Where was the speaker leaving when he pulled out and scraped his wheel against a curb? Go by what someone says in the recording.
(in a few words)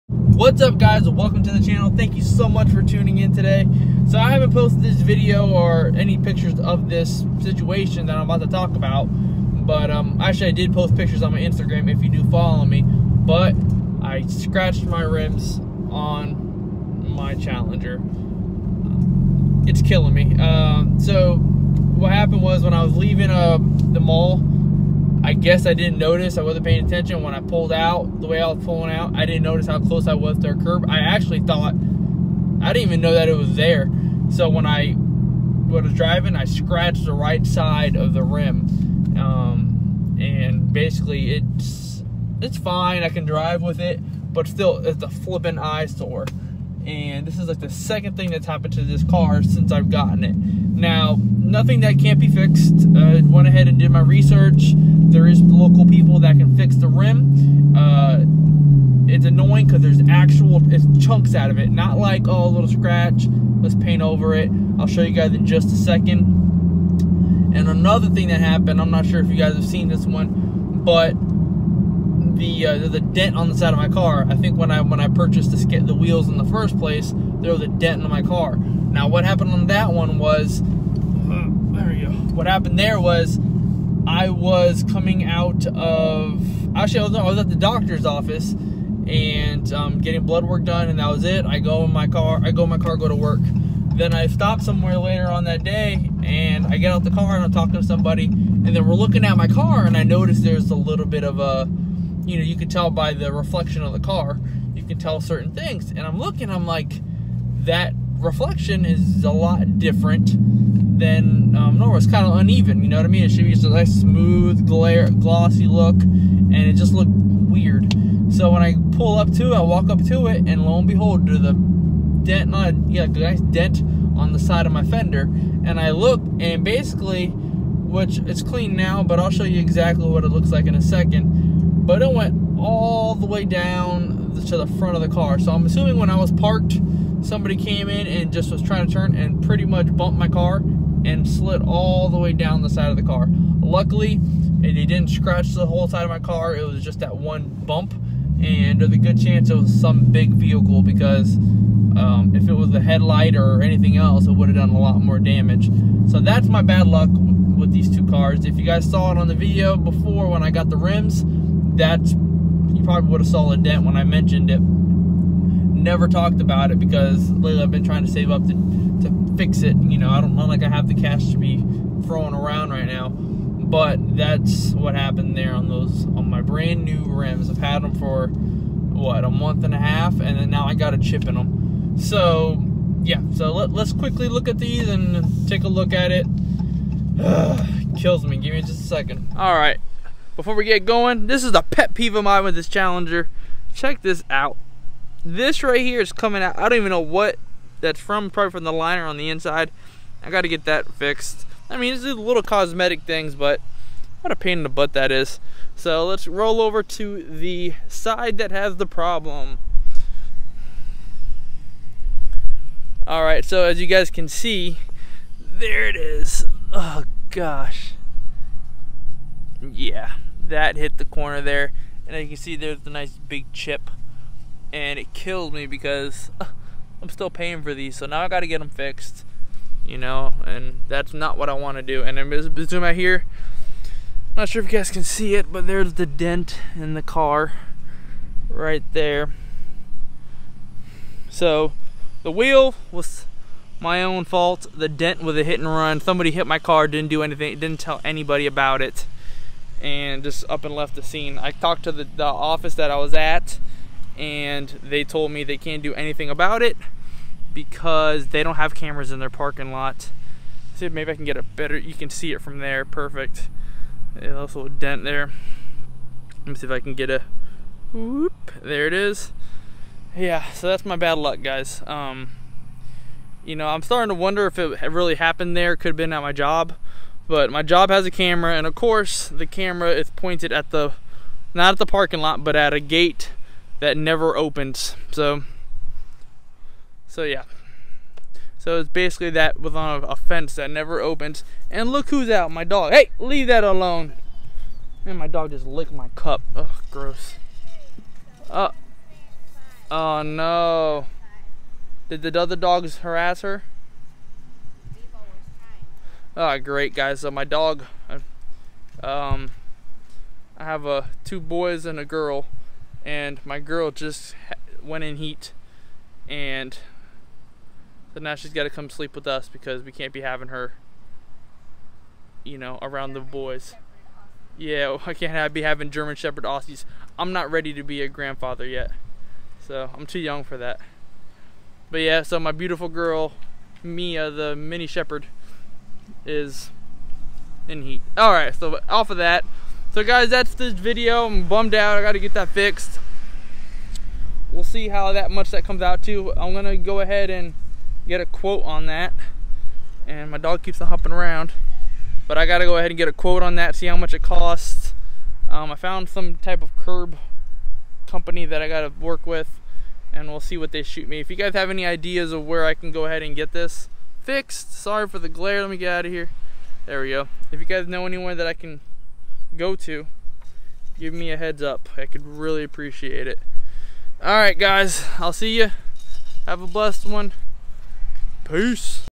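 the mall.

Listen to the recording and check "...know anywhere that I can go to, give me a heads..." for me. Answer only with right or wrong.
right.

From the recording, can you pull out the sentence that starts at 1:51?
It's kind of uneven, you know what I mean?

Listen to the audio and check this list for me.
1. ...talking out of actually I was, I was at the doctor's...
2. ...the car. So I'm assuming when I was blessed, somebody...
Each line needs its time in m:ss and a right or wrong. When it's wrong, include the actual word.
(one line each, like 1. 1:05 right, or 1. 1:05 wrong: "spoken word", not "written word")
1. 1:24 wrong: "coming", not "talking"
2. 2:15 wrong: "parked", not "blessed".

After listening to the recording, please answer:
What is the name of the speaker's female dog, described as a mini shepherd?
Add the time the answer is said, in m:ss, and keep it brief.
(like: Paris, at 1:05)
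Mia, at 5:33.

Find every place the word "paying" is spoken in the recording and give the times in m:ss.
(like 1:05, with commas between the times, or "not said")
0:26, 3:47.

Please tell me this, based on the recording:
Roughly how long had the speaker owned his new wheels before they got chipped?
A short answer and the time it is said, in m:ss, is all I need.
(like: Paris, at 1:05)
a month and a half, at 2:59.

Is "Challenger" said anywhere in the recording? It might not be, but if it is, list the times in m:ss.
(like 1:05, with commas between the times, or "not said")
0:17, 3:12.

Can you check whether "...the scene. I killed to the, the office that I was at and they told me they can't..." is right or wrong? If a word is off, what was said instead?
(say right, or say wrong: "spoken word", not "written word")
wrong: "talked", not "killed".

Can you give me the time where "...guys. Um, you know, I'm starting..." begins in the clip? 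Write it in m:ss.
4:31.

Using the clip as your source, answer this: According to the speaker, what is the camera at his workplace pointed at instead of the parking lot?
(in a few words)
a gate.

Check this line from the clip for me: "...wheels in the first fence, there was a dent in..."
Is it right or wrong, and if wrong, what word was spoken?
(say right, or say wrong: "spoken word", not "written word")
wrong: "place", not "fence".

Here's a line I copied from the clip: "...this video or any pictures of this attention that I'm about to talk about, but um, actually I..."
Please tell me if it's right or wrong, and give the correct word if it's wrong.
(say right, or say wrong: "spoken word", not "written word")
wrong: "situation", not "attention".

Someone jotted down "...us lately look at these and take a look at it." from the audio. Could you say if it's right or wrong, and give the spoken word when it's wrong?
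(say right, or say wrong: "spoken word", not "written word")
wrong: "quickly", not "lately".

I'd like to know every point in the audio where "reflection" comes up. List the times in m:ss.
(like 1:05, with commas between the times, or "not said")
1:43, 1:48.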